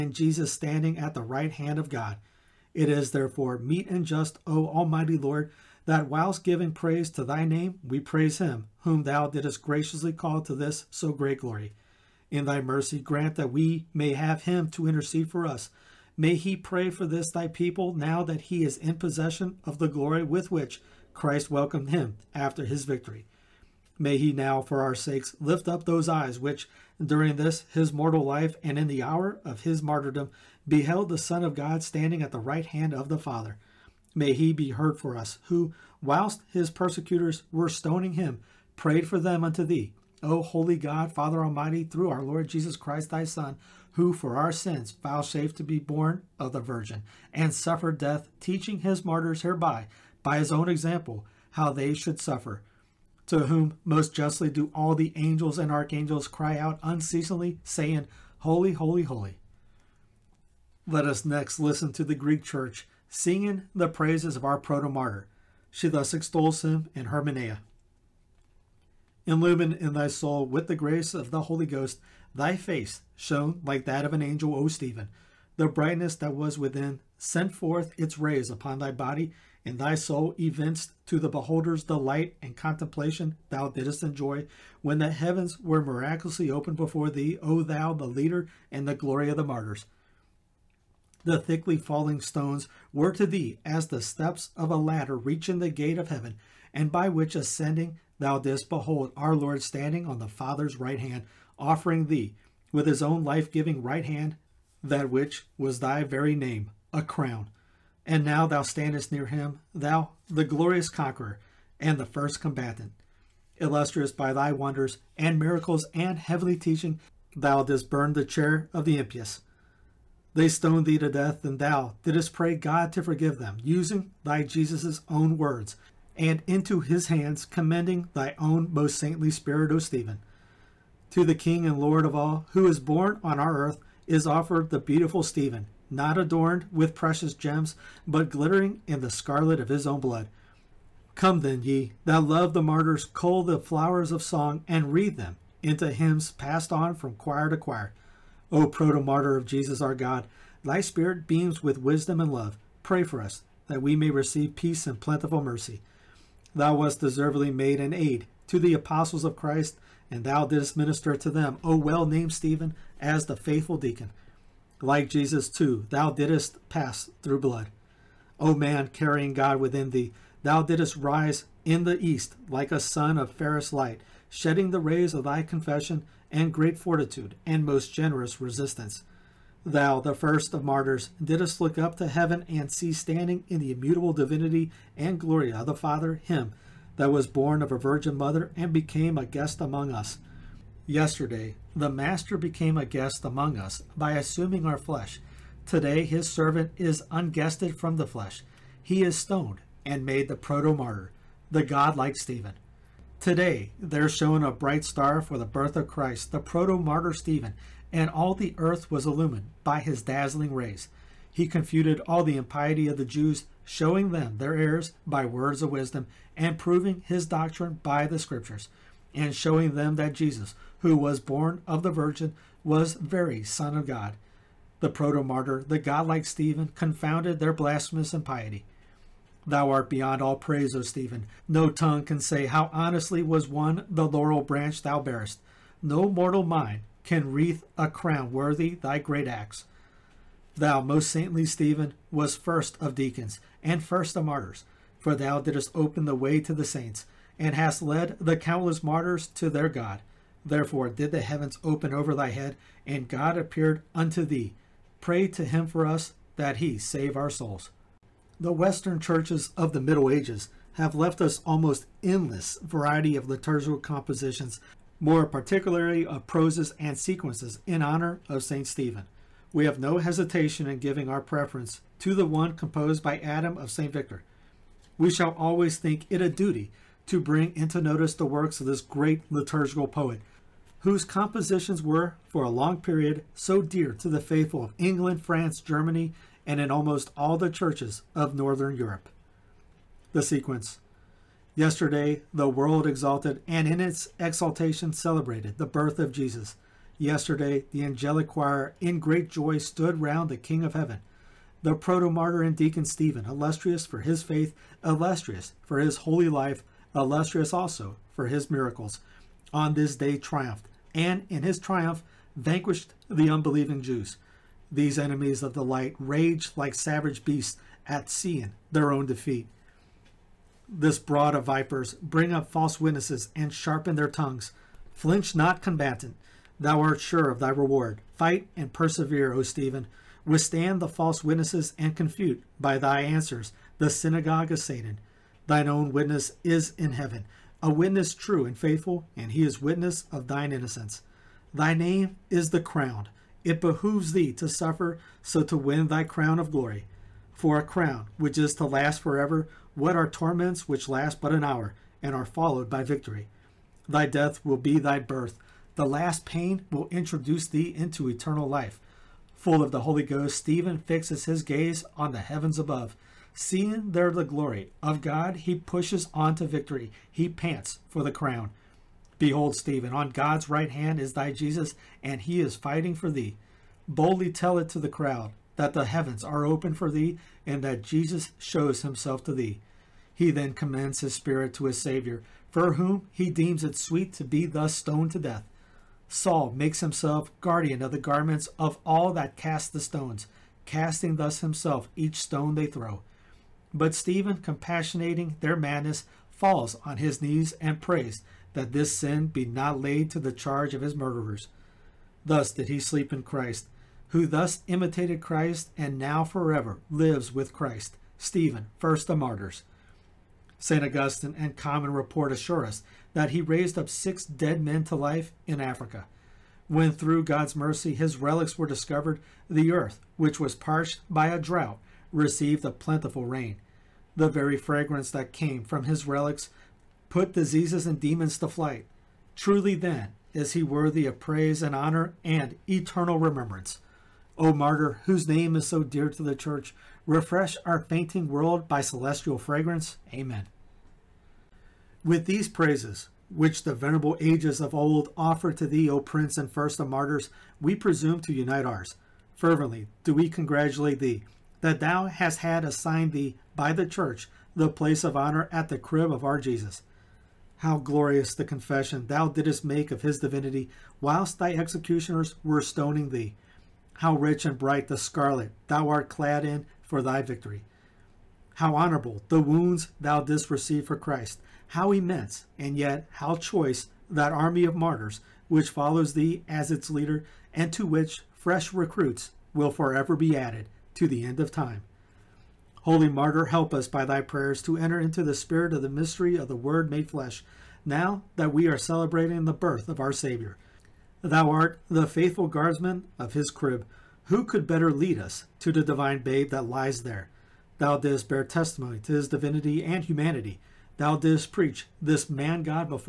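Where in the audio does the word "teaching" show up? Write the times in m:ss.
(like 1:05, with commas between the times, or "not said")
0:48, 1:56.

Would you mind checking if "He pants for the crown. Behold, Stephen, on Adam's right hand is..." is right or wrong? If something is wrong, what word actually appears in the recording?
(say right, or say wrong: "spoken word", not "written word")
wrong: "God", not "Adam".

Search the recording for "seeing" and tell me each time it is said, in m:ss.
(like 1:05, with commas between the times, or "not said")
5:18, 6:03.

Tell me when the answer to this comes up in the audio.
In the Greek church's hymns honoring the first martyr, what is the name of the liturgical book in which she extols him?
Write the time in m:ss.
1:07.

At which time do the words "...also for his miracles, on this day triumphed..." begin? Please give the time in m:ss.
5:07.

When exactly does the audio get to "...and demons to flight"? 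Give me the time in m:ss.
7:07.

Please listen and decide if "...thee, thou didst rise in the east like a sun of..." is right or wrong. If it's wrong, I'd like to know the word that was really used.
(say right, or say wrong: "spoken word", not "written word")
right.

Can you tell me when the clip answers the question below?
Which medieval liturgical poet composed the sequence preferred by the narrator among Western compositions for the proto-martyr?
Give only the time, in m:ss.
4:33.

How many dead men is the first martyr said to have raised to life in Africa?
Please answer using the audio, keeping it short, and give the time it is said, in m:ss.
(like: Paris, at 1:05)
6, at 6:53.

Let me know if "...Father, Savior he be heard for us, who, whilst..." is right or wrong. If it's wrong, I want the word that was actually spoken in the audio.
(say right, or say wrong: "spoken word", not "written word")
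wrong: "May", not "Savior".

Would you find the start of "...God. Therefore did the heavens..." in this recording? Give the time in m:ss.
4:09.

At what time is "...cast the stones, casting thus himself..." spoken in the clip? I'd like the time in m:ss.
6:29.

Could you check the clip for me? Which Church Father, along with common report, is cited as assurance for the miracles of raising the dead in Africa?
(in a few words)
St. Augustine.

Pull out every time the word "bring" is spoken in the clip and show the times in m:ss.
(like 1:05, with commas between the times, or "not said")
4:37, 5:21.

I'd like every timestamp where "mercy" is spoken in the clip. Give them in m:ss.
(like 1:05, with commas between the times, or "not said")
0:12, 2:35, 6:57.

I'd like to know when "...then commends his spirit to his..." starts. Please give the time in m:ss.
6:20.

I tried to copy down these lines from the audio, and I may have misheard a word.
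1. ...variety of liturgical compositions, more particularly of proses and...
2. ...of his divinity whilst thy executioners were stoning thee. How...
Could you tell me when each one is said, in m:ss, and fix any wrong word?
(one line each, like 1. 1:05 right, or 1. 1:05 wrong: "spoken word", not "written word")
1. 4:22 right
2. 7:39 right.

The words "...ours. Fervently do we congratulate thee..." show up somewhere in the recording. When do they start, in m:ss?
7:28.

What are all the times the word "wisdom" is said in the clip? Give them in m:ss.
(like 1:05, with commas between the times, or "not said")
2:31, 3:35.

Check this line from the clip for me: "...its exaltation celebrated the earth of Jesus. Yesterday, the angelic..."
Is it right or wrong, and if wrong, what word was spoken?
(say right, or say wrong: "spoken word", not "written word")
wrong: "birth", not "earth".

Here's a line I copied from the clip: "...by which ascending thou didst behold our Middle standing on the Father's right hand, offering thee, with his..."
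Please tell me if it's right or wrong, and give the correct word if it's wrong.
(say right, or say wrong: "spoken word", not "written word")
wrong: "Lord", not "Middle".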